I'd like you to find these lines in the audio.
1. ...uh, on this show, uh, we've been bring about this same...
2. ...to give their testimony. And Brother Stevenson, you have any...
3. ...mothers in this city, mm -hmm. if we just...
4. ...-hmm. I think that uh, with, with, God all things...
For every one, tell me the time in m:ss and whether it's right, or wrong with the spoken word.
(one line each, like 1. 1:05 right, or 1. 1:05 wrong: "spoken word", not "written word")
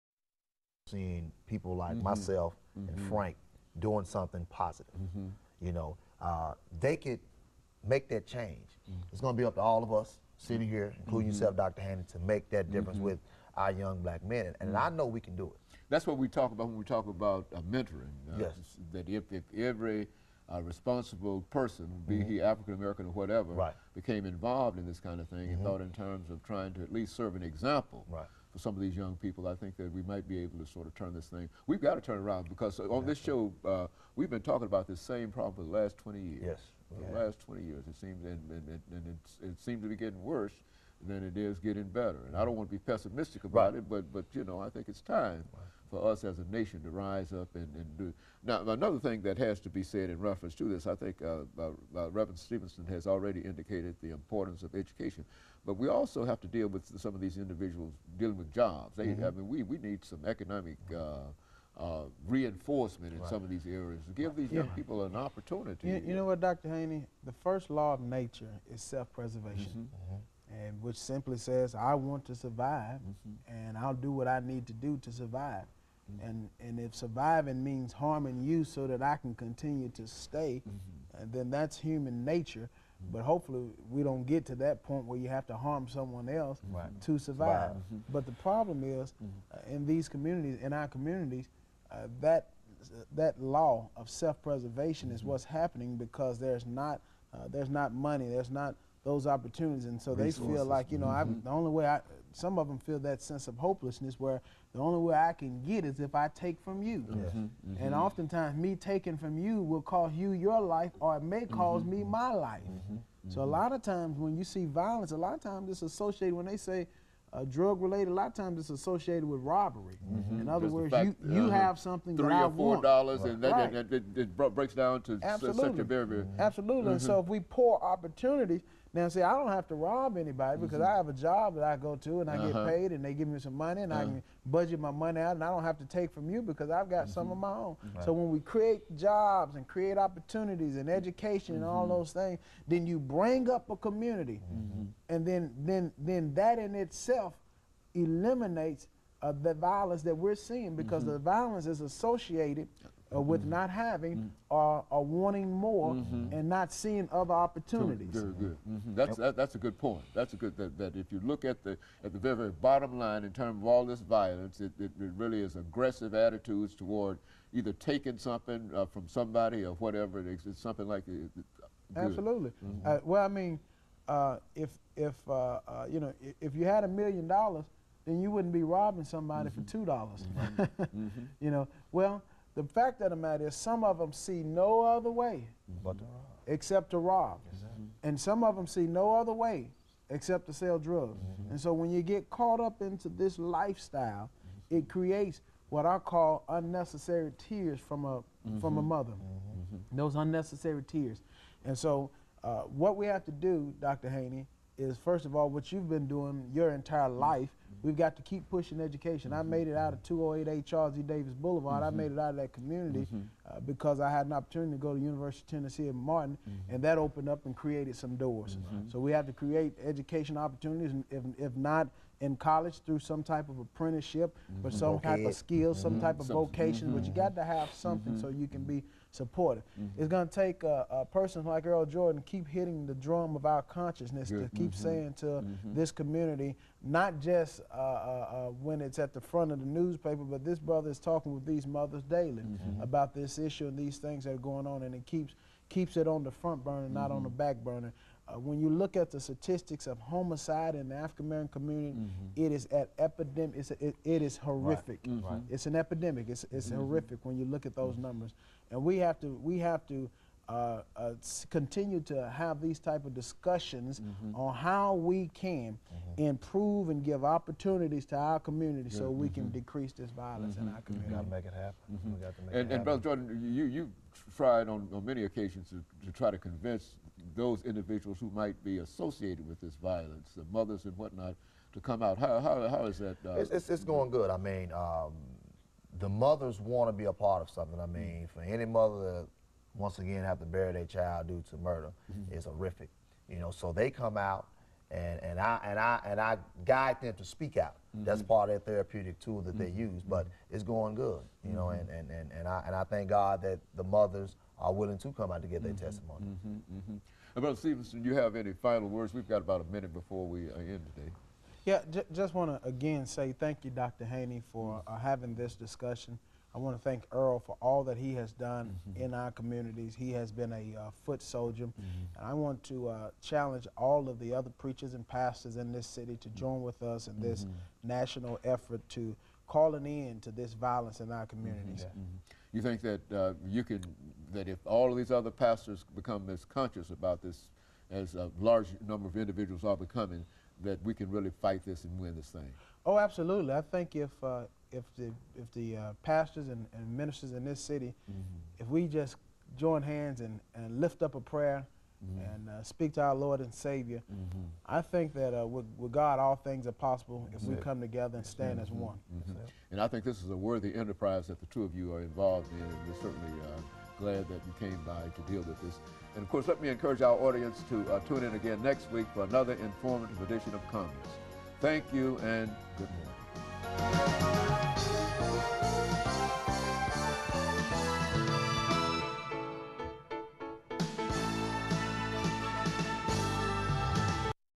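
1. 0:32 wrong: "talking", not "bring"
2. 5:05 right
3. 5:46 wrong: "ministers", not "mothers"
4. 5:54 right.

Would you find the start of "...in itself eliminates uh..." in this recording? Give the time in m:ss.
2:26.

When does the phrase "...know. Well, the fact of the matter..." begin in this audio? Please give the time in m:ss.
3:01.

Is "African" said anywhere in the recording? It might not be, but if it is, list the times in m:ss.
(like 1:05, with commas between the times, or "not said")
0:22, 4:10.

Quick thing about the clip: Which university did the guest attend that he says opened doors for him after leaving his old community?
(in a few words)
University of Tennessee at Martin.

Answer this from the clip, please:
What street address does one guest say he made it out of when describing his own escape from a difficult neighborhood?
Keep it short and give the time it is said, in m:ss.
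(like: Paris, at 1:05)
2088 Charles E. Davis Boulevard, at 3:30.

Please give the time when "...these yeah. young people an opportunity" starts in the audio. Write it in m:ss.
1:04.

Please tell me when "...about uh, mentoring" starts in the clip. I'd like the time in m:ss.
0:17.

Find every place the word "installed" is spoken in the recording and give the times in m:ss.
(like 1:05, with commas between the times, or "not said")
not said.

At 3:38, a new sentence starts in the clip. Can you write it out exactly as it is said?
So we have to create education opportunities, and if, if not, in college through some type of apprenticeship mm or some okay.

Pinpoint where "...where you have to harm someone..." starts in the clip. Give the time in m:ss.
1:25.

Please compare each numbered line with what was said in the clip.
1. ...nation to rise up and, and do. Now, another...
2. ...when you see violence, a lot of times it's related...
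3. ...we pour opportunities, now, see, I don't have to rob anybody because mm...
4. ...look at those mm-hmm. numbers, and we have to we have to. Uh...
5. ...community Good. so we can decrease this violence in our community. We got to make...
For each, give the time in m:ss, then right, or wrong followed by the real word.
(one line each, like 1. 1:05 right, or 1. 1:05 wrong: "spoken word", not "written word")
1. 0:46 right
2. 1:54 wrong: "associated", not "related"
3. 2:07 right
4. 4:17 right
5. 4:28 right.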